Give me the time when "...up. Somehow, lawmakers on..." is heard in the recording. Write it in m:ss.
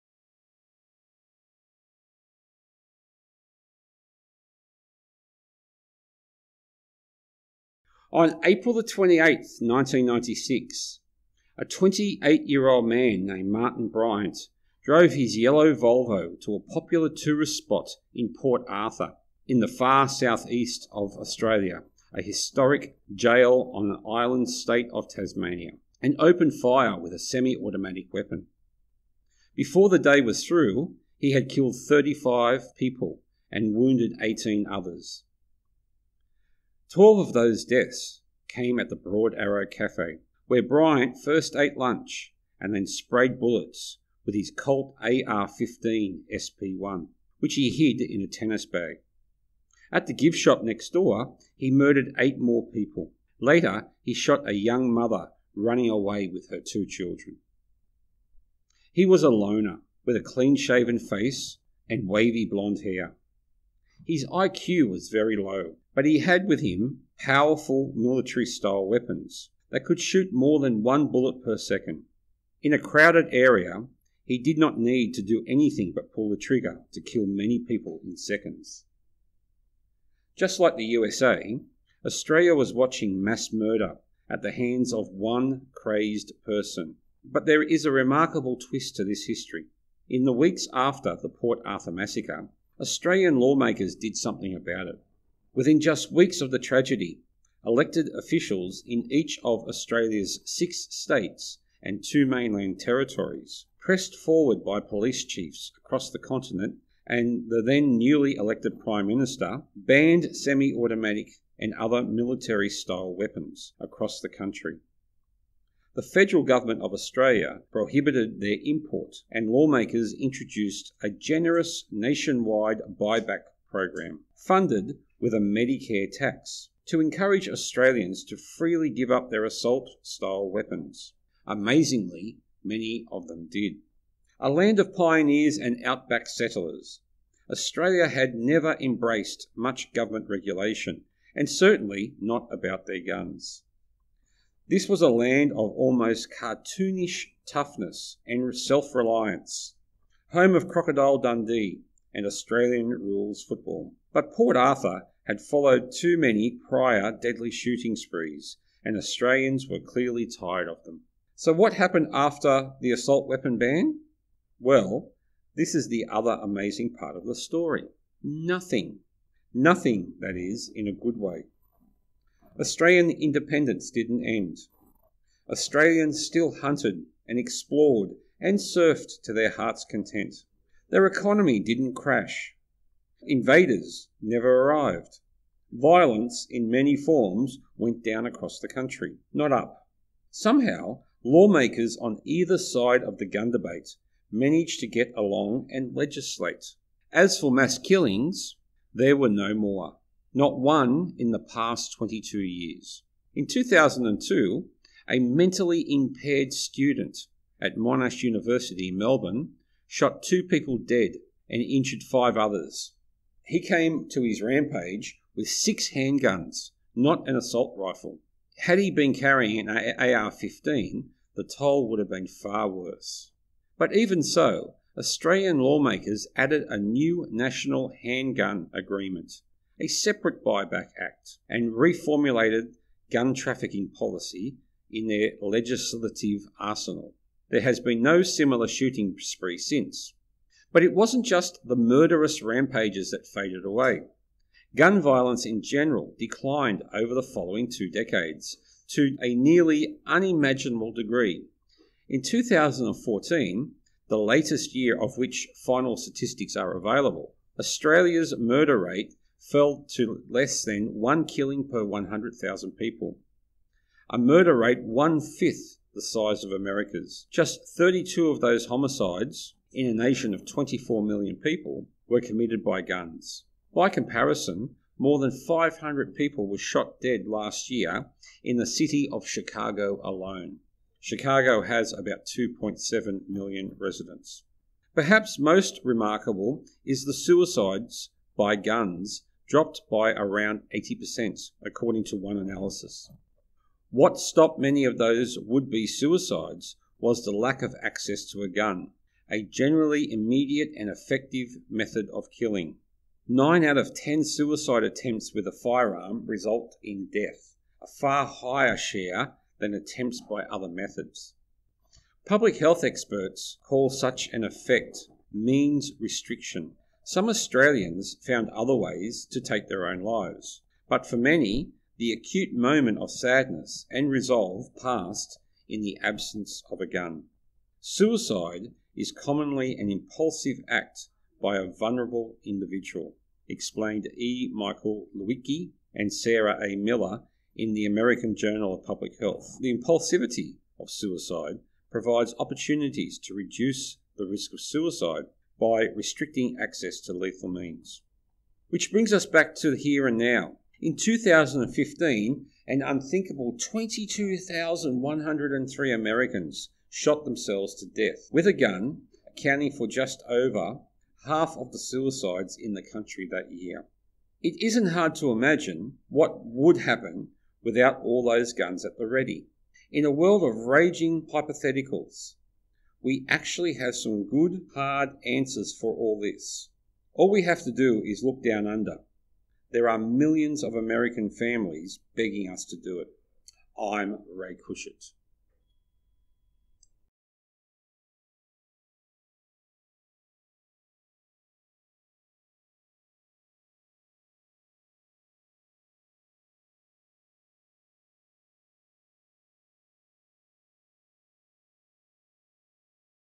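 3:09.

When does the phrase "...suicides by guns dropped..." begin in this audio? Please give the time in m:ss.
4:47.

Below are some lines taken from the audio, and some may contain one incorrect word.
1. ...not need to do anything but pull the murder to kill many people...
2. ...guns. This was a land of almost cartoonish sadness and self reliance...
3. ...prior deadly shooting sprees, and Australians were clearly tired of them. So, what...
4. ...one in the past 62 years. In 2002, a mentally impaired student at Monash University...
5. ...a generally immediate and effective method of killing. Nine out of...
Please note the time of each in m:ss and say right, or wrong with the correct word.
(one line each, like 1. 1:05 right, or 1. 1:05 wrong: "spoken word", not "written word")
1. 1:14 wrong: "trigger", not "murder"
2. 2:23 wrong: "toughness", not "sadness"
3. 2:36 right
4. 3:20 wrong: "22", not "62"
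5. 4:59 right.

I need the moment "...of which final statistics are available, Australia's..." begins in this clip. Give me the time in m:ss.
4:15.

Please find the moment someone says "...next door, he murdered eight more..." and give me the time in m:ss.
0:50.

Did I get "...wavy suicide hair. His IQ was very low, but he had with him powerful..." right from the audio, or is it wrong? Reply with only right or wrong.
wrong.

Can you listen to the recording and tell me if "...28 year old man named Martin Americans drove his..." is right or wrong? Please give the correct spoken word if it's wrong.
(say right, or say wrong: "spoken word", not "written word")
wrong: "Bryant", not "Americans".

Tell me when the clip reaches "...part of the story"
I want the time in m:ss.
2:46.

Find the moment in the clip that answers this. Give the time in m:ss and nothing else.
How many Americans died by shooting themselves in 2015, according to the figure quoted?
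5:53.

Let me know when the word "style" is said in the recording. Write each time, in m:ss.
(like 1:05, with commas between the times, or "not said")
1:08, 1:52, 2:10.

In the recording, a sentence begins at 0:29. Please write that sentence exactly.
Before the day was through, he had killed 35 people and wounded 18 others.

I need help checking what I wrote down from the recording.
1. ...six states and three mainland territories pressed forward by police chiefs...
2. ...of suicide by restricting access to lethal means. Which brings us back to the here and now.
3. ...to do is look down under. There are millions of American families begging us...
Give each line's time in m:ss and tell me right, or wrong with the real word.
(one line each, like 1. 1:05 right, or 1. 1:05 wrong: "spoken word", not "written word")
1. 1:40 wrong: "two", not "three"
2. 5:44 right
3. 6:17 right.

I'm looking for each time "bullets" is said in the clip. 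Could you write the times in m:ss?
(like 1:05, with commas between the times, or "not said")
0:43, 1:11.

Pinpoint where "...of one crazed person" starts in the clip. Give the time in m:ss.
1:24.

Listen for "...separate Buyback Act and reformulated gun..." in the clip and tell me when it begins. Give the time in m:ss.
3:49.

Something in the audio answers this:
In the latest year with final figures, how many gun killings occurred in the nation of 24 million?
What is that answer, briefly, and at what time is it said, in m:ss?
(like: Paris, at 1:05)
32, at 4:27.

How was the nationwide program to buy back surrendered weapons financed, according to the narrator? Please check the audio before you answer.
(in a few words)
A Medicare tax.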